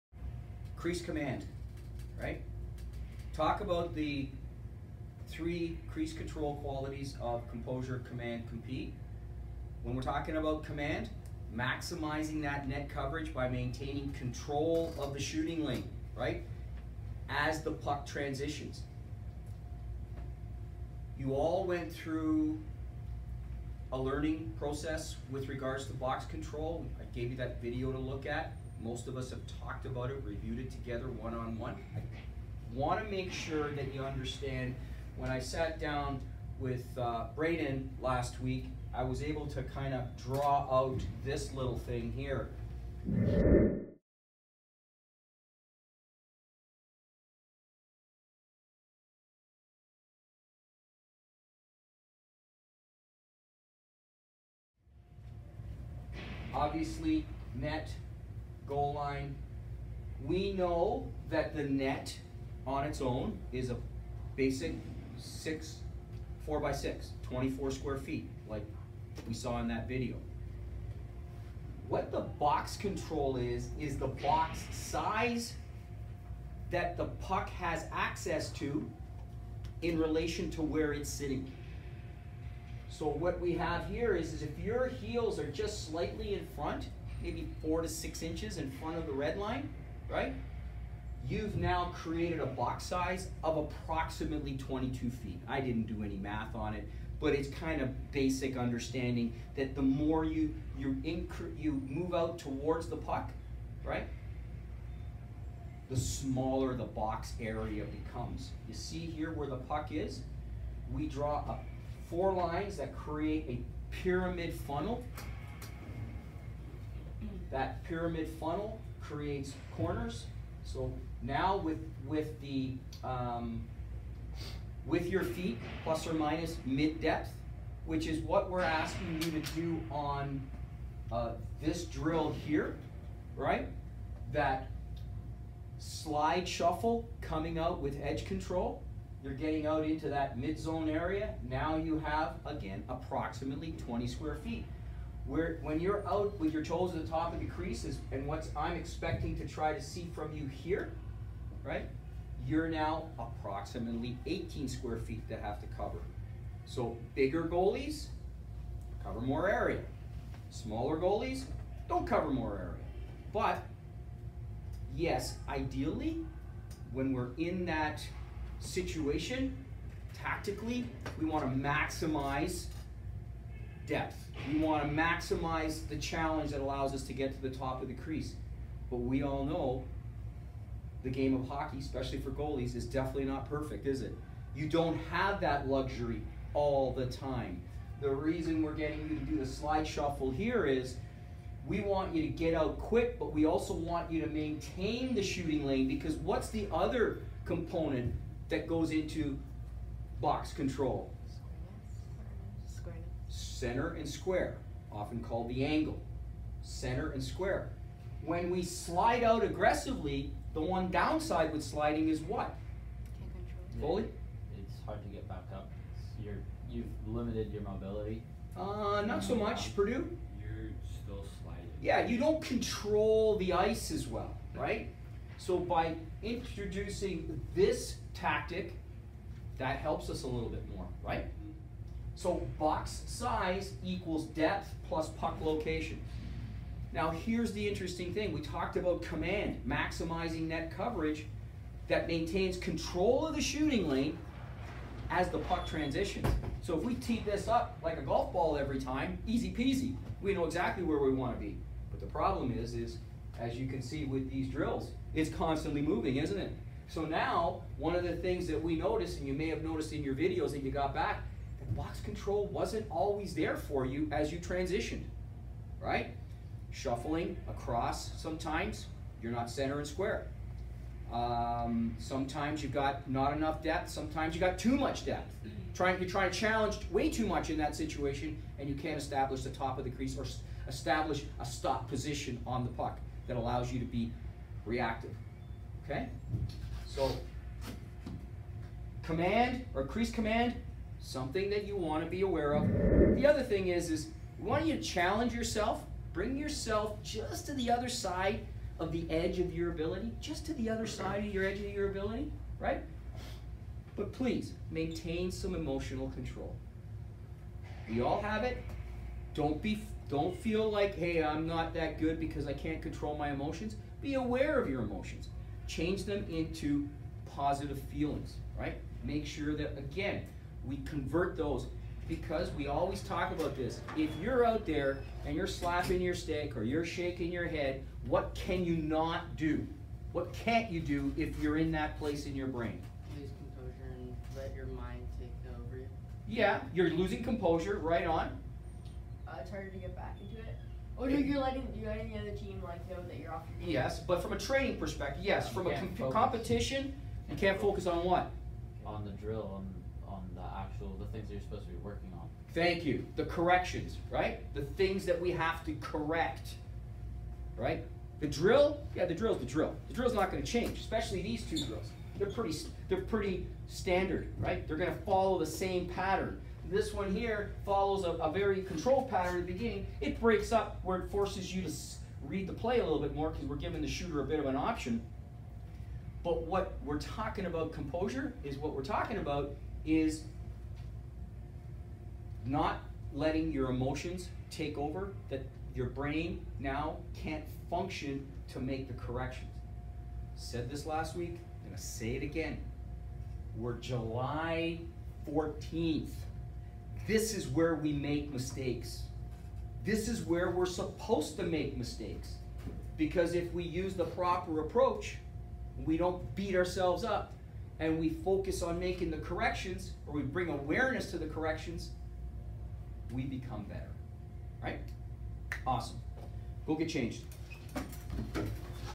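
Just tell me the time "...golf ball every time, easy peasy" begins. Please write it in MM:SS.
04:08.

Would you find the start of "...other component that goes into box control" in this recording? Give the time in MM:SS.
03:16.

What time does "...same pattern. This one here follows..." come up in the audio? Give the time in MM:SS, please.
06:05.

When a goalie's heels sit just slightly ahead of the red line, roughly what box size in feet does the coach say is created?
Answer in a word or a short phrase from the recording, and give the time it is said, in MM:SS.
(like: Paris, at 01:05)
22, at 01:34.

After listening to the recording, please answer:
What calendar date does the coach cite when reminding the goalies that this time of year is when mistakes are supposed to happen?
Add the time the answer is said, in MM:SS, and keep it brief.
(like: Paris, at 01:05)
July 14th, at 06:33.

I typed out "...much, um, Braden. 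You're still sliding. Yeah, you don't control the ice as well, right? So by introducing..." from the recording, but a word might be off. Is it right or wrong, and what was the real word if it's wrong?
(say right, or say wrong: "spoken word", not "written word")
wrong: "Purdue", not "Braden".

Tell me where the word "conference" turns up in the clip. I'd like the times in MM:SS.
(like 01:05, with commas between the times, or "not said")
not said.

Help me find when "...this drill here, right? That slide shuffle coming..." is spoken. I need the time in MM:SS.
02:11.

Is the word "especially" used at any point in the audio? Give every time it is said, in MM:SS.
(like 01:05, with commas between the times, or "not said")
03:01, 06:00.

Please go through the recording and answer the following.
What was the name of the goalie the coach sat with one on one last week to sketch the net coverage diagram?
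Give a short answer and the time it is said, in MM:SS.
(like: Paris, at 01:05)
Braden, at 00:37.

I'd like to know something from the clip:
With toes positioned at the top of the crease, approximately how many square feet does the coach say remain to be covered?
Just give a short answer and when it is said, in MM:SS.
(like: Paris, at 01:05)
18, at 02:34.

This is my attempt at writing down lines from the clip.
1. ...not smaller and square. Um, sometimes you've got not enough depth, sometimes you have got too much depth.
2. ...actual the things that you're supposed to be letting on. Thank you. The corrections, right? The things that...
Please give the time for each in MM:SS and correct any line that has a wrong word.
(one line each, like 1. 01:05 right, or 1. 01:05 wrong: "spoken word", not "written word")
1. 04:29 wrong: "center", not "smaller"
2. 05:50 wrong: "working", not "letting".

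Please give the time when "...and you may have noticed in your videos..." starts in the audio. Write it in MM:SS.
04:19.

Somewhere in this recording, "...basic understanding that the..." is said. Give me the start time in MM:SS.
01:38.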